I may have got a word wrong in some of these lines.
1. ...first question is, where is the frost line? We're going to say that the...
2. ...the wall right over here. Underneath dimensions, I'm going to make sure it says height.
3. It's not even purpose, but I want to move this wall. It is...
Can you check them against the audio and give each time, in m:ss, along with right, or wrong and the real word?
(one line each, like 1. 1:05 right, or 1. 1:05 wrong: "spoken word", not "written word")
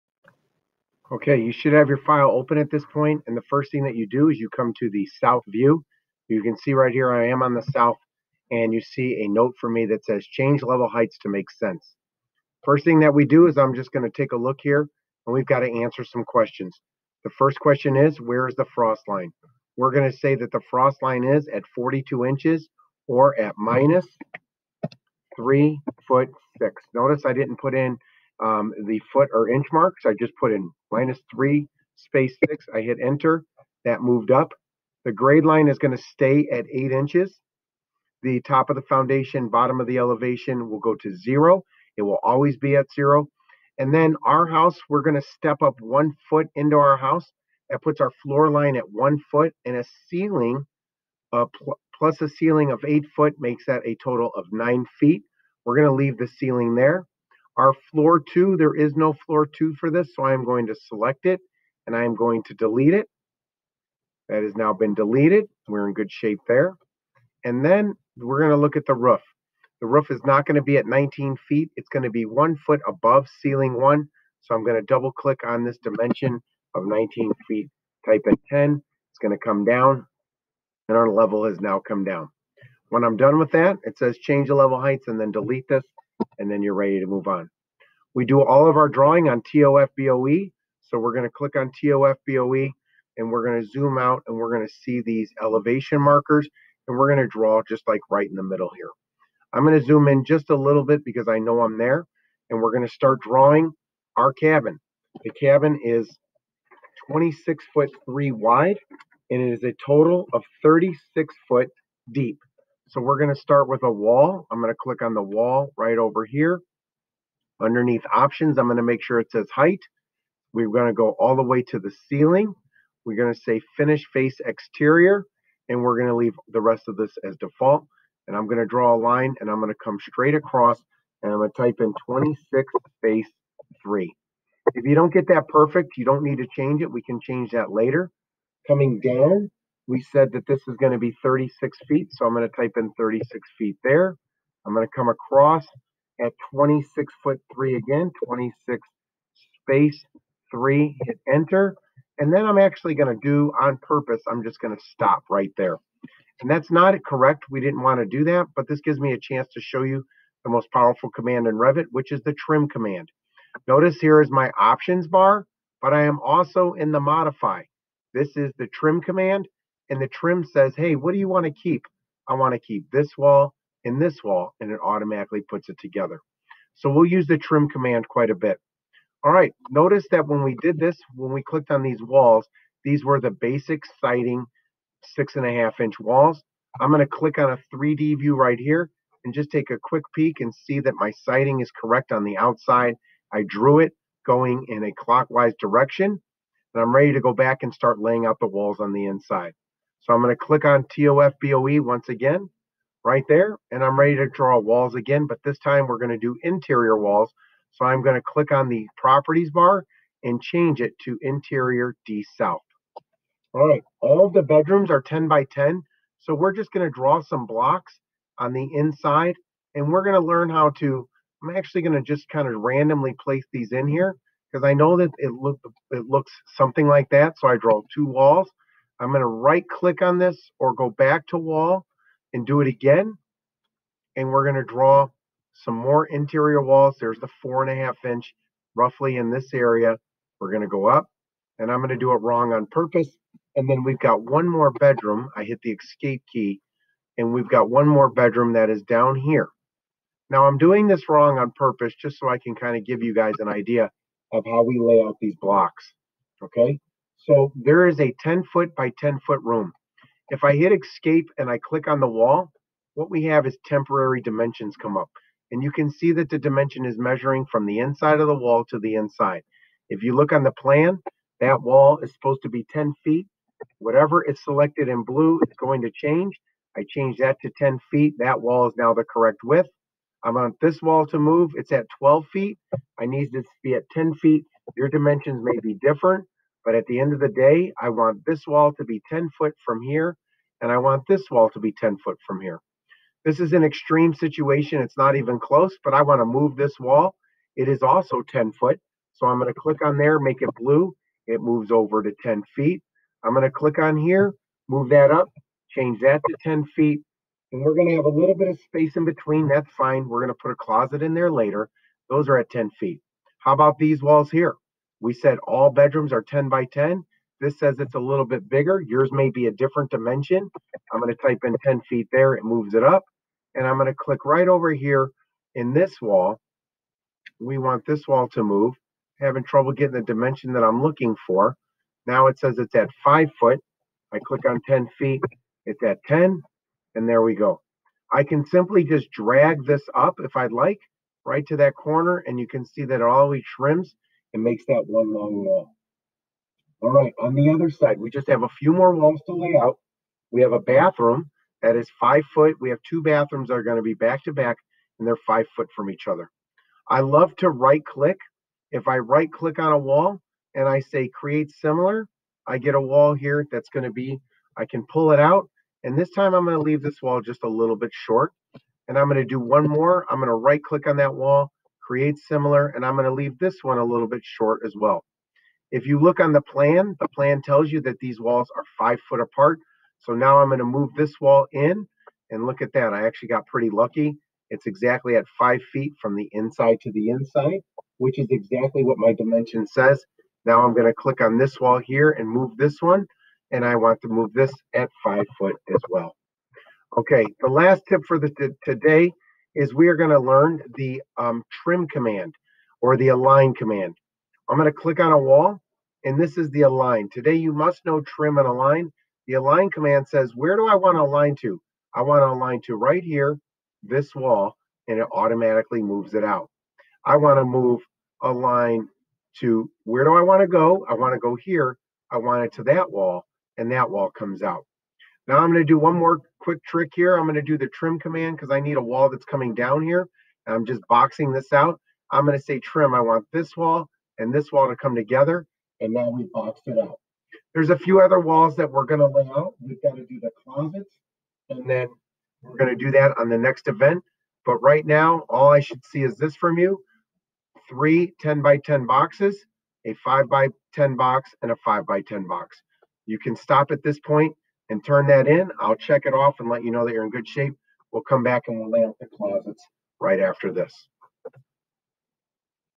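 1. 0:17 right
2. 1:55 wrong: "options", not "dimensions"
3. 4:54 wrong: "close", not "purpose".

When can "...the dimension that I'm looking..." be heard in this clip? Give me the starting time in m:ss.
5:29.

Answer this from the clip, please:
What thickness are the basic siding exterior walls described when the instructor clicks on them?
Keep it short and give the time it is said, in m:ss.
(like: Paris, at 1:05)
6.5 inches, at 3:05.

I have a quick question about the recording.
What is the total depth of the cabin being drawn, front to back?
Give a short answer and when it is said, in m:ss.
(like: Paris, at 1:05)
36 feet, at 1:49.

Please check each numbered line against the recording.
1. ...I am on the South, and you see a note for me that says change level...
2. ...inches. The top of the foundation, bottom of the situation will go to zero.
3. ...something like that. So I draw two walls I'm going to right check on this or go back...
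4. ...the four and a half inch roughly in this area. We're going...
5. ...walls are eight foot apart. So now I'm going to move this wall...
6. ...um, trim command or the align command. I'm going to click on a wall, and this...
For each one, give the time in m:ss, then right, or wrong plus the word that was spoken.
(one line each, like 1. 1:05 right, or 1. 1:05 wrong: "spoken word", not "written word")
1. 0:07 right
2. 0:36 wrong: "elevation", not "situation"
3. 3:46 wrong: "click", not "check"
4. 3:57 right
5. 6:18 wrong: "five", not "eight"
6. 6:41 right.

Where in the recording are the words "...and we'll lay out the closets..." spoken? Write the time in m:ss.
7:38.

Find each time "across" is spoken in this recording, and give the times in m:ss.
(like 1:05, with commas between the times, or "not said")
2:10, 2:25.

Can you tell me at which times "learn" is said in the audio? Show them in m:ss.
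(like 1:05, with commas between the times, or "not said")
3:40, 6:40.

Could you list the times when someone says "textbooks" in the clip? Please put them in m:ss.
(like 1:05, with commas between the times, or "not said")
not said.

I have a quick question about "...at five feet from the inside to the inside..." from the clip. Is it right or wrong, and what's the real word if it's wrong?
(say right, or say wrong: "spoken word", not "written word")
right.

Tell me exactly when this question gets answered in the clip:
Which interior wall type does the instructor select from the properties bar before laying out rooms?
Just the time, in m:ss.
3:31.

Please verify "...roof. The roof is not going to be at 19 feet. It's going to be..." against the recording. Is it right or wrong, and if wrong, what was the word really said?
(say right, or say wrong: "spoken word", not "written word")
right.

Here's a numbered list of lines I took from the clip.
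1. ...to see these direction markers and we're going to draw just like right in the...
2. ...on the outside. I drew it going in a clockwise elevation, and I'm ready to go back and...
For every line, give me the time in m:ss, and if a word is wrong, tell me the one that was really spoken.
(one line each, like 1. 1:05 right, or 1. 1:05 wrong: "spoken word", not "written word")
1. 1:34 wrong: "elevation", not "direction"
2. 3:12 wrong: "direction", not "elevation".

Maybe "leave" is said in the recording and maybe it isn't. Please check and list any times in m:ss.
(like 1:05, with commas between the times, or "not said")
0:55, 2:06, 6:06, 6:13.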